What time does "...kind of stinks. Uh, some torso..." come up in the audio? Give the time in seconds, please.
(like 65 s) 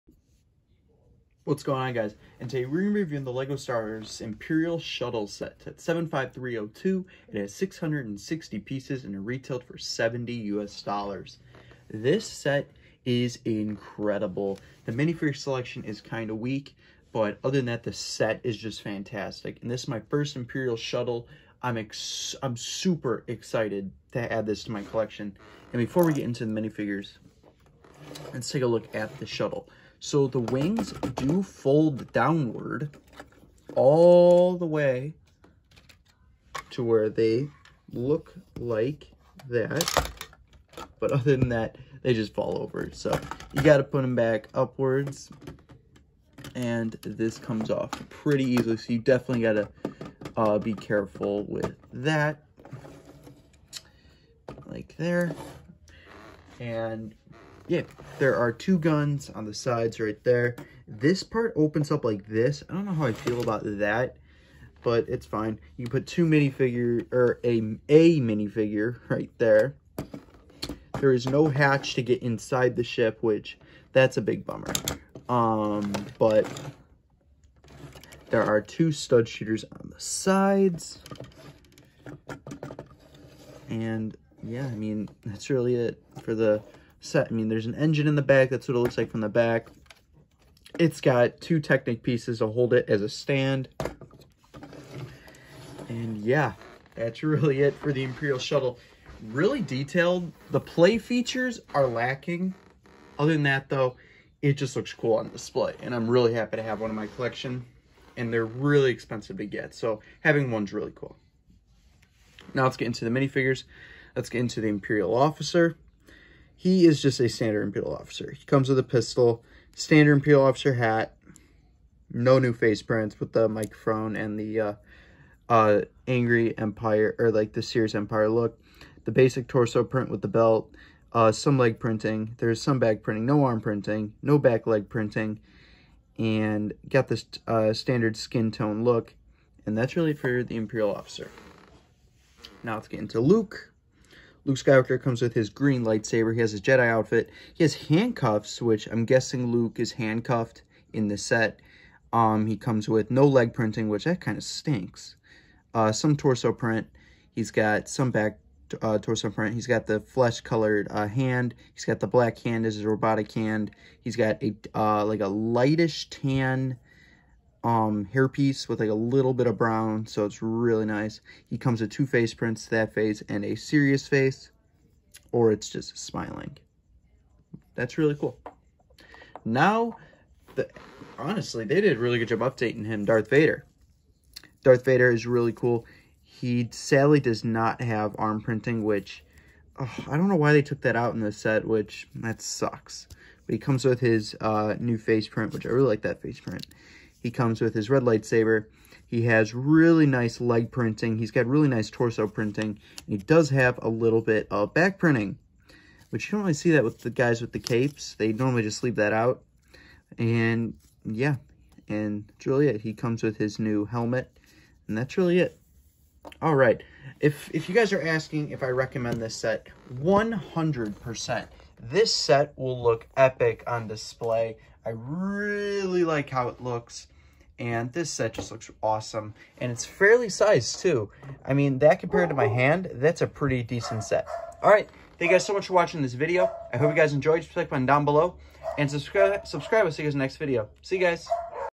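154 s.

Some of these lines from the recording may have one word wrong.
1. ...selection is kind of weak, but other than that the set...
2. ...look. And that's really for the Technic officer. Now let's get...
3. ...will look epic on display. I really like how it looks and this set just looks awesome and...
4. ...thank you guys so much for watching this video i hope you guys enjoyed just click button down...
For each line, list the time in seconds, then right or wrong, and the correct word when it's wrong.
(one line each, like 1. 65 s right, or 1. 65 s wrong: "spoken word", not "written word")
1. 15 s right
2. 138 s wrong: "Imperial", not "Technic"
3. 222 s right
4. 235 s right.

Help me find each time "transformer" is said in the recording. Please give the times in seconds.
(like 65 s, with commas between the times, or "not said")
not said.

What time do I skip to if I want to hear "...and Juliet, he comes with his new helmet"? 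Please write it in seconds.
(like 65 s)
211 s.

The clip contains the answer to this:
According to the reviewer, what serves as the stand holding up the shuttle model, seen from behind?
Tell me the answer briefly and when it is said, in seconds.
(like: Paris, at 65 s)
Two Technic pieces, at 91 s.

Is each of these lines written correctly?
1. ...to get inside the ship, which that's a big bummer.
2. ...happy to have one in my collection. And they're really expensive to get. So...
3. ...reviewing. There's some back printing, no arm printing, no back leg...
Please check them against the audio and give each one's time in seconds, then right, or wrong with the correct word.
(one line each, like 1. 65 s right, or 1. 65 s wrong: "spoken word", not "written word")
1. 71 s right
2. 106 s right
3. 131 s wrong: "printing", not "reviewing".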